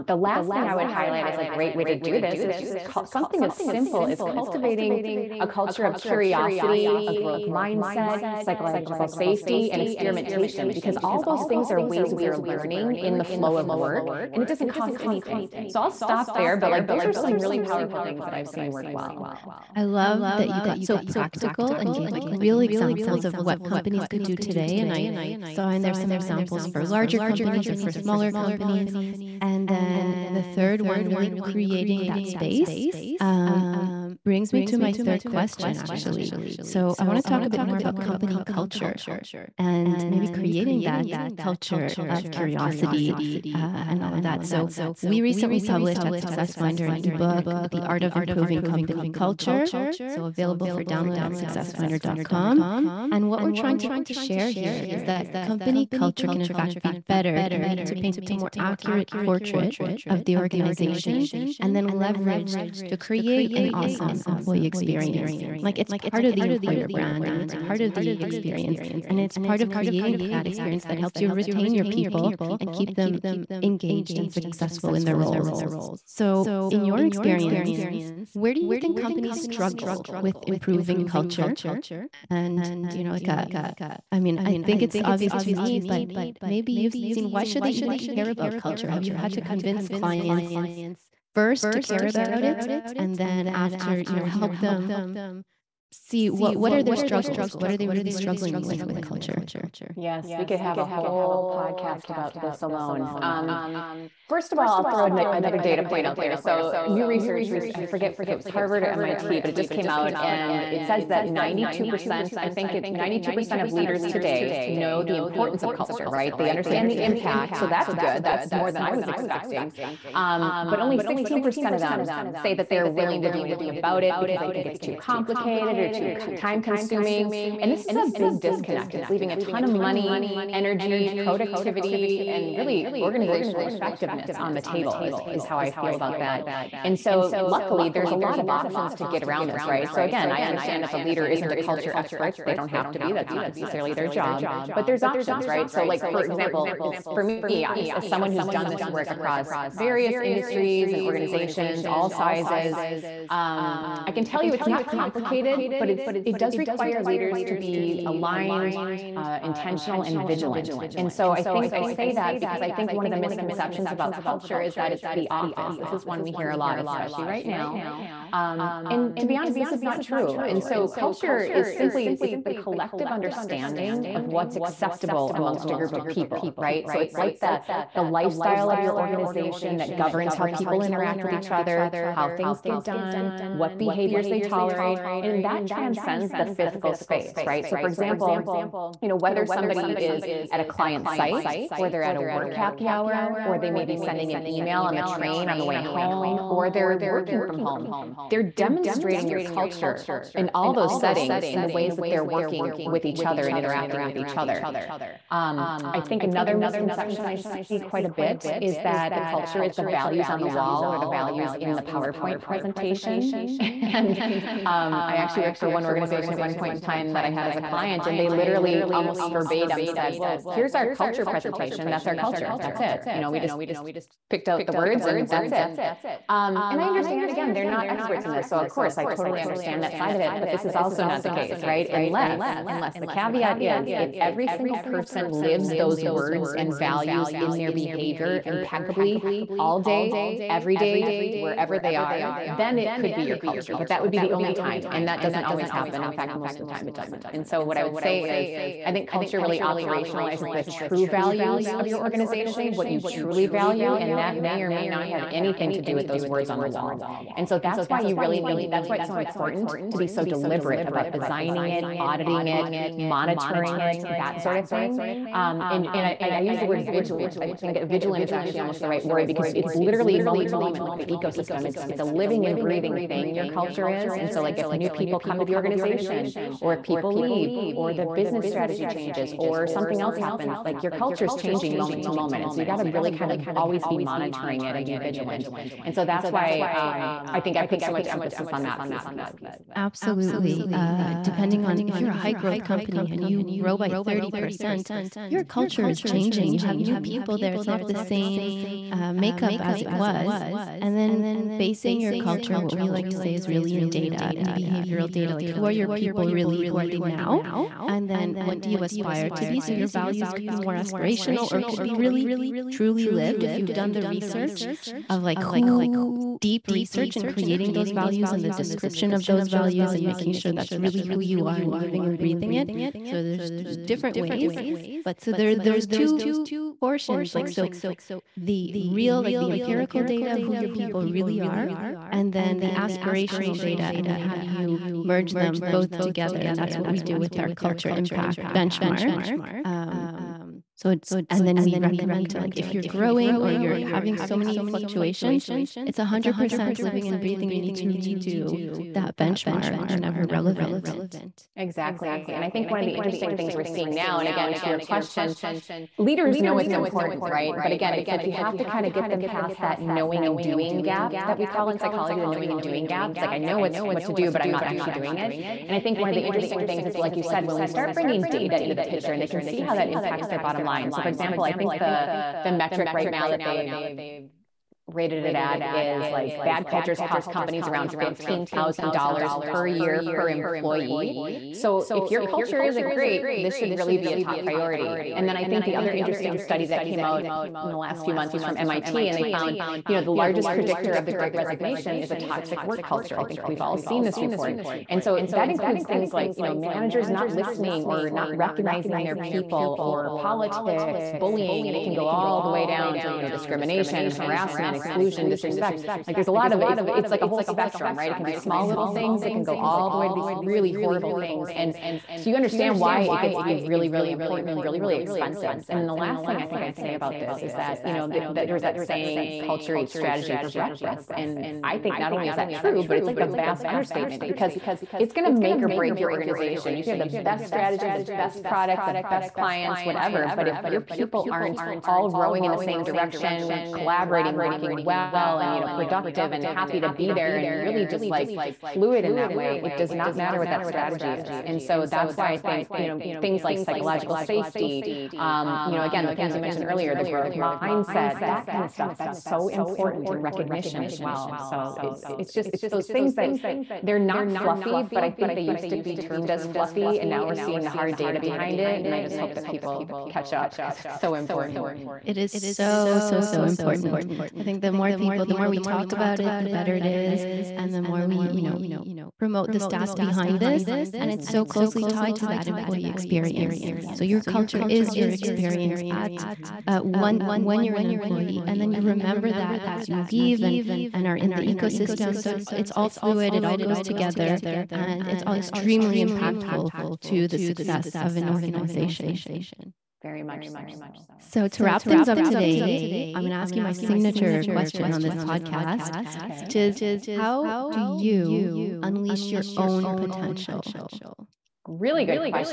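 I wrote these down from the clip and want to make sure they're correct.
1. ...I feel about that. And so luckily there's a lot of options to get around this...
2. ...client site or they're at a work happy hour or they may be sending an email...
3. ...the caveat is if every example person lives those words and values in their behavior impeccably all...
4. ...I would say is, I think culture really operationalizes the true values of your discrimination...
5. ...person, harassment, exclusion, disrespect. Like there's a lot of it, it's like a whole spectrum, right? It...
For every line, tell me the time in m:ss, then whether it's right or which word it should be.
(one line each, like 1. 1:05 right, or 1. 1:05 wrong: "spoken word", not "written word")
1. 2:15 right
2. 3:10 right
3. 3:52 wrong: "single", not "example"
4. 4:07 wrong: "organization", not "discrimination"
5. 6:43 wrong: "discrimination", not "person".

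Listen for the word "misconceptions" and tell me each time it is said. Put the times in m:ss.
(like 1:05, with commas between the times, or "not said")
2:43, 3:26.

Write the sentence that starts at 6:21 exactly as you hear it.
So if your culture isn't great, this should really be a top priority.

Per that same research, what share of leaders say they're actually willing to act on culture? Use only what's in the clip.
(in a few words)
16%.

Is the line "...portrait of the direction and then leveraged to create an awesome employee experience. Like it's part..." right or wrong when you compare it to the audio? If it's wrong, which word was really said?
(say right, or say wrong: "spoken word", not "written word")
wrong: "organization", not "direction".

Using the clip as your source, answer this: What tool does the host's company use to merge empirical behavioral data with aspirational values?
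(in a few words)
culture impact benchmark.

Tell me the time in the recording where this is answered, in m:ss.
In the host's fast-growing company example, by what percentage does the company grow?
4:53.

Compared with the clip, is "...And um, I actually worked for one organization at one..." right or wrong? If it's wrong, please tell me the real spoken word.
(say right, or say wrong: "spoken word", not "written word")
right.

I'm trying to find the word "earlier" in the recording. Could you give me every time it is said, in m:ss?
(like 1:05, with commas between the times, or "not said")
7:26.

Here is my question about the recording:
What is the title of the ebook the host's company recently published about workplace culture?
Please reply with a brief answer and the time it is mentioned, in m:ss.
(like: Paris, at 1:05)
The Art of Improving Company Culture, at 0:47.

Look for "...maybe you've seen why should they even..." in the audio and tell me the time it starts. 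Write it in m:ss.
1:26.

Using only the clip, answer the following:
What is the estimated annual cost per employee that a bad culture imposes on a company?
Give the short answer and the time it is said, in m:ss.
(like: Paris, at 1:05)
$15,000, at 6:17.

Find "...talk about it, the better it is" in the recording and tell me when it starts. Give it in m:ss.
7:45.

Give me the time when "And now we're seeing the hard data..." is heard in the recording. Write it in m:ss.
7:36.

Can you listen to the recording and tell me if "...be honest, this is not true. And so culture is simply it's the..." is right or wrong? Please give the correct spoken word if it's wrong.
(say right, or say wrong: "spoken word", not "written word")
right.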